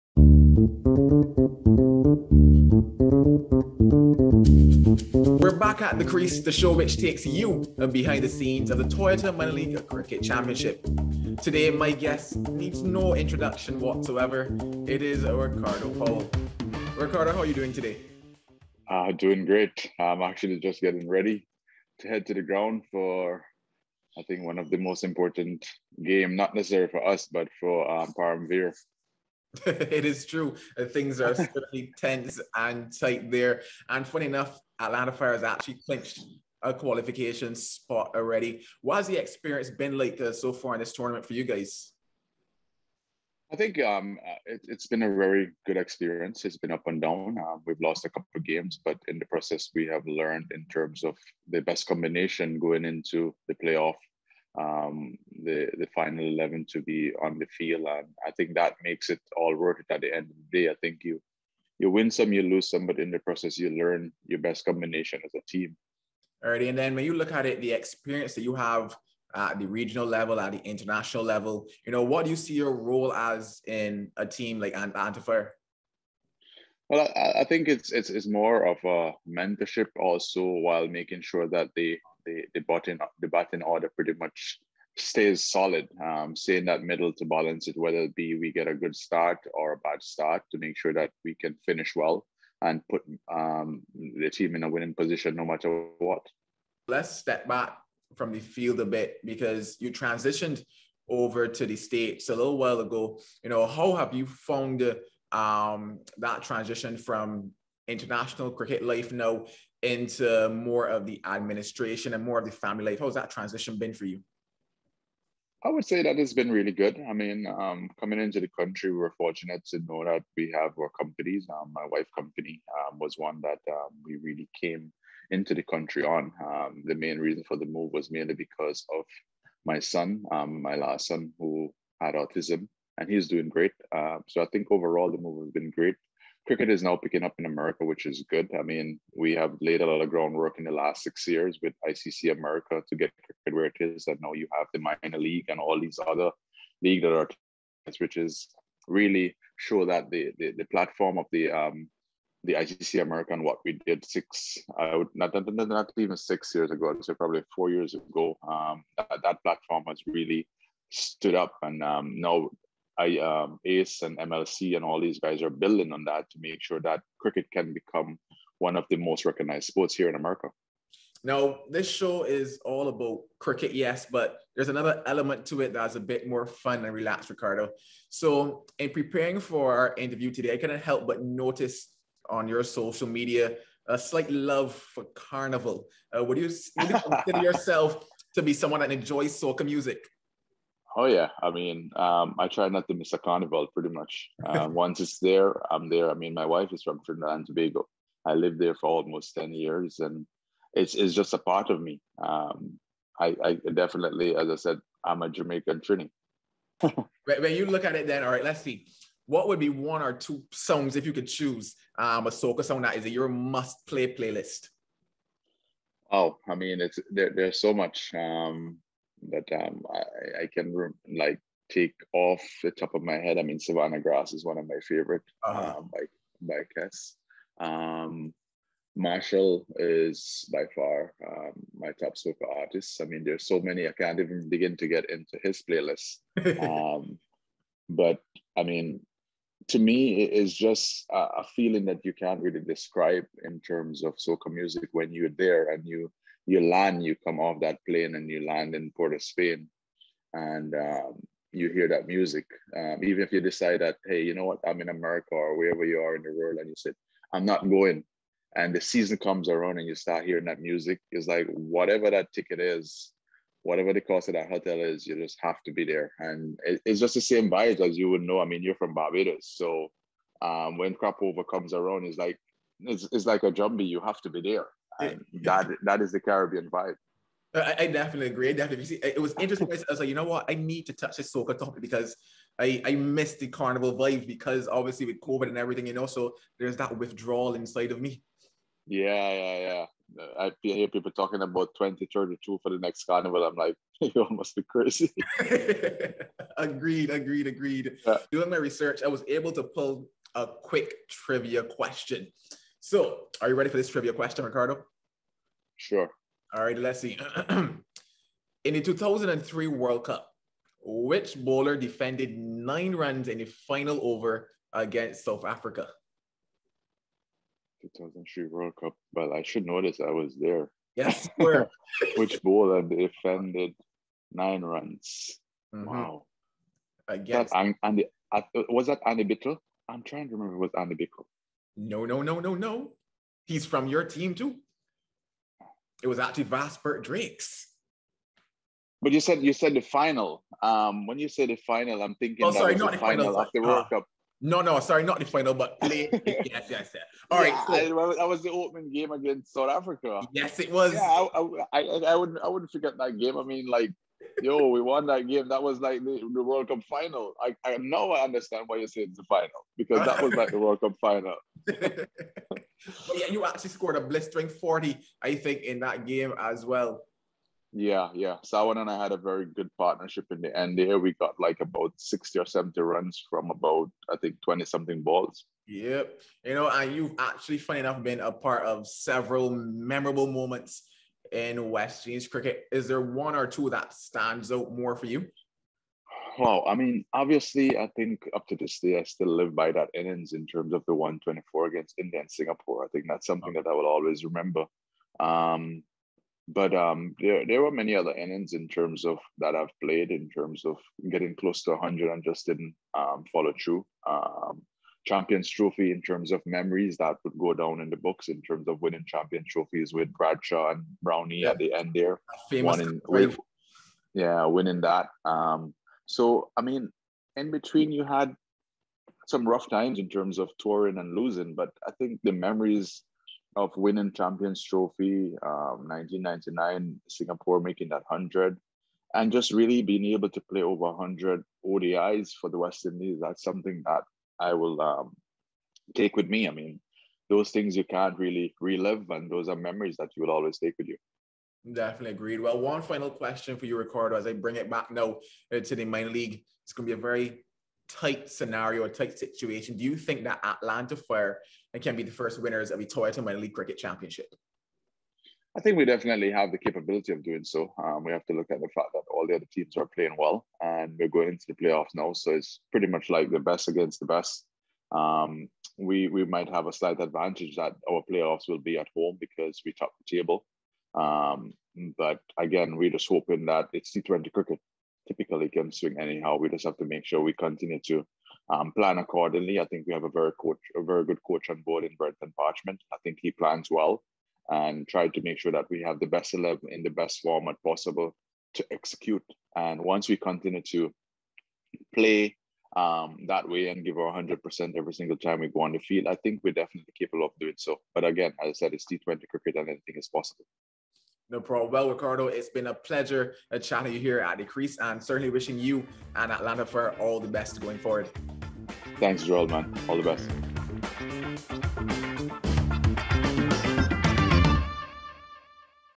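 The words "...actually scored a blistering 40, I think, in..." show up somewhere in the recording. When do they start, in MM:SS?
06:03.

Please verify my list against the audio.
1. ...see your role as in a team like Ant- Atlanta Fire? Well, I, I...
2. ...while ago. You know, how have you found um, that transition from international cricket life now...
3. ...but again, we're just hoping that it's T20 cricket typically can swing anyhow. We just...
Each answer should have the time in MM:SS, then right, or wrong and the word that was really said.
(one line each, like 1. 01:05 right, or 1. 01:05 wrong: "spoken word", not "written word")
1. 01:12 right
2. 01:42 right
3. 07:51 right.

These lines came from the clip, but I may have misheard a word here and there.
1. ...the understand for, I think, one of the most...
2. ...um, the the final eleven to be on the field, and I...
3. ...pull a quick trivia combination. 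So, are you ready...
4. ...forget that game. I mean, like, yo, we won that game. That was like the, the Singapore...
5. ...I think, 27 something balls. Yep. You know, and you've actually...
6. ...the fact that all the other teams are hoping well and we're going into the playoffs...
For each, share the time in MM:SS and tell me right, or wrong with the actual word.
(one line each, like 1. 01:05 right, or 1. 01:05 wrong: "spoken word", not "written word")
1. 00:22 wrong: "ground", not "understand"
2. 00:54 right
3. 04:59 wrong: "question", not "combination"
4. 05:52 wrong: "World", not "Singapore"
5. 06:14 wrong: "20", not "27"
6. 07:38 wrong: "playing", not "hoping".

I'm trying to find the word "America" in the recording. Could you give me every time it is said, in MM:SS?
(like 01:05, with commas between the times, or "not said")
02:17, 02:22, 02:33, 02:50, 04:14.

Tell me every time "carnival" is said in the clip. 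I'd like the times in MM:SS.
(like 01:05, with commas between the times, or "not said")
03:05, 03:13, 04:43, 04:53.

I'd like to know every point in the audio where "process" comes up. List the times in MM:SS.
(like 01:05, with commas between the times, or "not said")
00:49, 01:03.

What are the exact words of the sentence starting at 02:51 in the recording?
Now, this show is all about cricket, yes, but there's another element to it that's a bit more fun and relaxed, Ricardo.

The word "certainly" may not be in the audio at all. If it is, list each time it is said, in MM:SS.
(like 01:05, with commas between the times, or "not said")
00:31, 08:25.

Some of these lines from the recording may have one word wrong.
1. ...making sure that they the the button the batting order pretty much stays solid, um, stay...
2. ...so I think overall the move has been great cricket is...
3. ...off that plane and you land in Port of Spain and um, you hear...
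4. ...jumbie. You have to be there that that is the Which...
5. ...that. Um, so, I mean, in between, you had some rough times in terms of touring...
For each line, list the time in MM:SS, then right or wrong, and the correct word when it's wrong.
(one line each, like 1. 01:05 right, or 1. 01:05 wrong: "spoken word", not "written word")
1. 01:20 right
2. 02:14 right
3. 04:07 right
4. 04:33 wrong: "Caribbean", not "Which"
5. 06:54 right.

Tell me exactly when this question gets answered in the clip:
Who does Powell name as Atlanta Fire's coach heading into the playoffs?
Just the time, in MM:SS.
08:01.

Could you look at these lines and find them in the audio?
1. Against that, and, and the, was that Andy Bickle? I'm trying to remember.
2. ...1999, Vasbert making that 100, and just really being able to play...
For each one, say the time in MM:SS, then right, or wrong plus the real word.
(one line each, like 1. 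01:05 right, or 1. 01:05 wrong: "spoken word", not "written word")
1. 05:27 right
2. 07:05 wrong: "Singapore", not "Vasbert".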